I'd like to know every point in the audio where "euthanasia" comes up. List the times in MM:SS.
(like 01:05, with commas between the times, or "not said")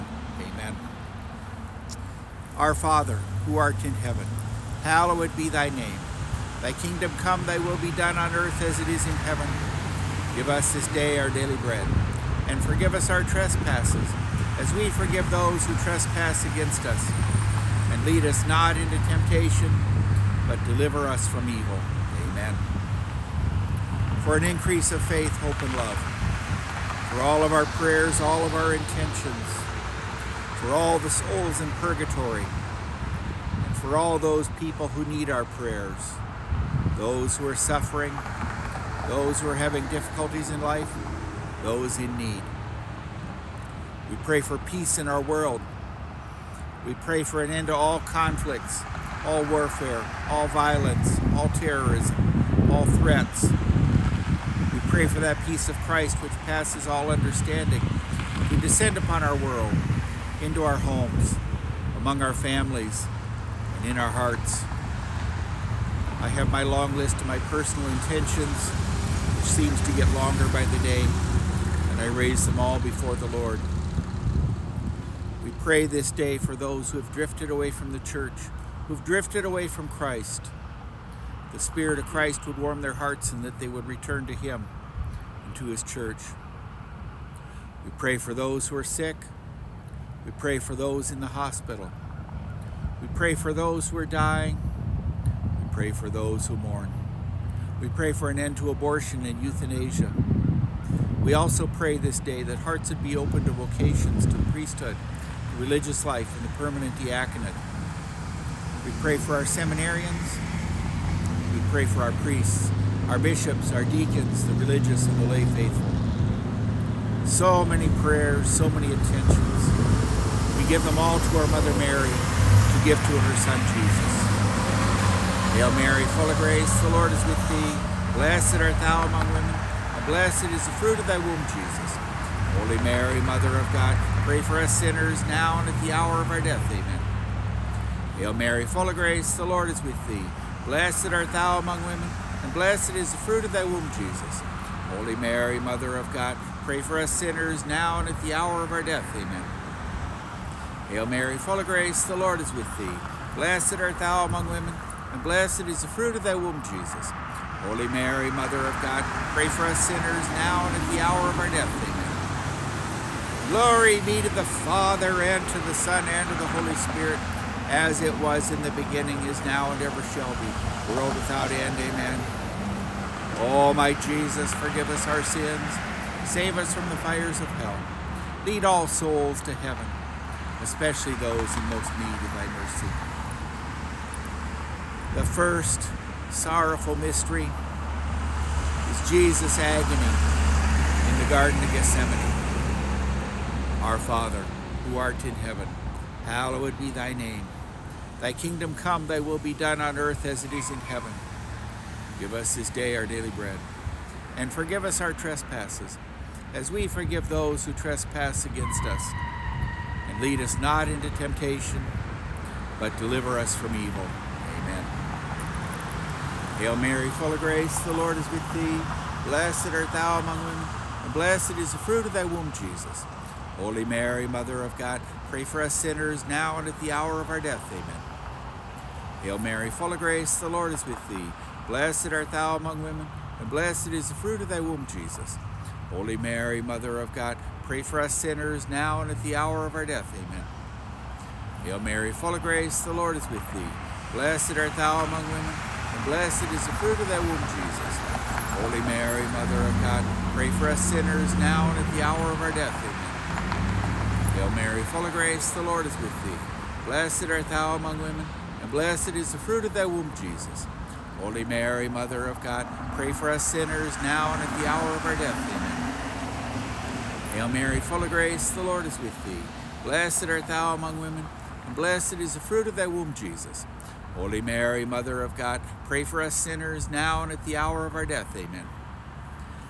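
01:39.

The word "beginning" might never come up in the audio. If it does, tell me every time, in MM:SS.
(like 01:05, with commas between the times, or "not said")
02:48.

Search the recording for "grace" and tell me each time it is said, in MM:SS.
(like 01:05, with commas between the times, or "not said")
02:06, 02:18, 02:31, 03:37, 03:49, 04:02, 04:15, 04:28.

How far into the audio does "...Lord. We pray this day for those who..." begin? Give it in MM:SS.
01:13.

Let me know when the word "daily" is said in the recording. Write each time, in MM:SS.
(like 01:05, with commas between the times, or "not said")
00:11, 03:23.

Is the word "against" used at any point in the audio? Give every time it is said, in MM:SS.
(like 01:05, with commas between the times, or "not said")
00:16, 03:28.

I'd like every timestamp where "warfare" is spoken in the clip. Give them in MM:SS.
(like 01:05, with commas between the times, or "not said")
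00:49.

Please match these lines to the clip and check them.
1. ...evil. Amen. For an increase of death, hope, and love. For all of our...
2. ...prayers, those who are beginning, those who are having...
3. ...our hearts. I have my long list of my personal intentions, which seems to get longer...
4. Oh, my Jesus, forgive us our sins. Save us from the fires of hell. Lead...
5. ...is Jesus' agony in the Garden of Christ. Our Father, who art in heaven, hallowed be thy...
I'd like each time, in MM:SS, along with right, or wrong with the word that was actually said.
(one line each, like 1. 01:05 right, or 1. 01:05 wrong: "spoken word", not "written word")
1. 00:21 wrong: "faith", not "death"
2. 00:35 wrong: "suffering", not "beginning"
3. 01:03 right
4. 02:53 right
5. 03:08 wrong: "Gethsemane", not "Christ".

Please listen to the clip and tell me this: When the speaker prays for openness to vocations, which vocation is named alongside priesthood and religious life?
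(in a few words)
permanent diaconate.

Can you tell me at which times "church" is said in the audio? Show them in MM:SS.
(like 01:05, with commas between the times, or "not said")
01:17, 01:25.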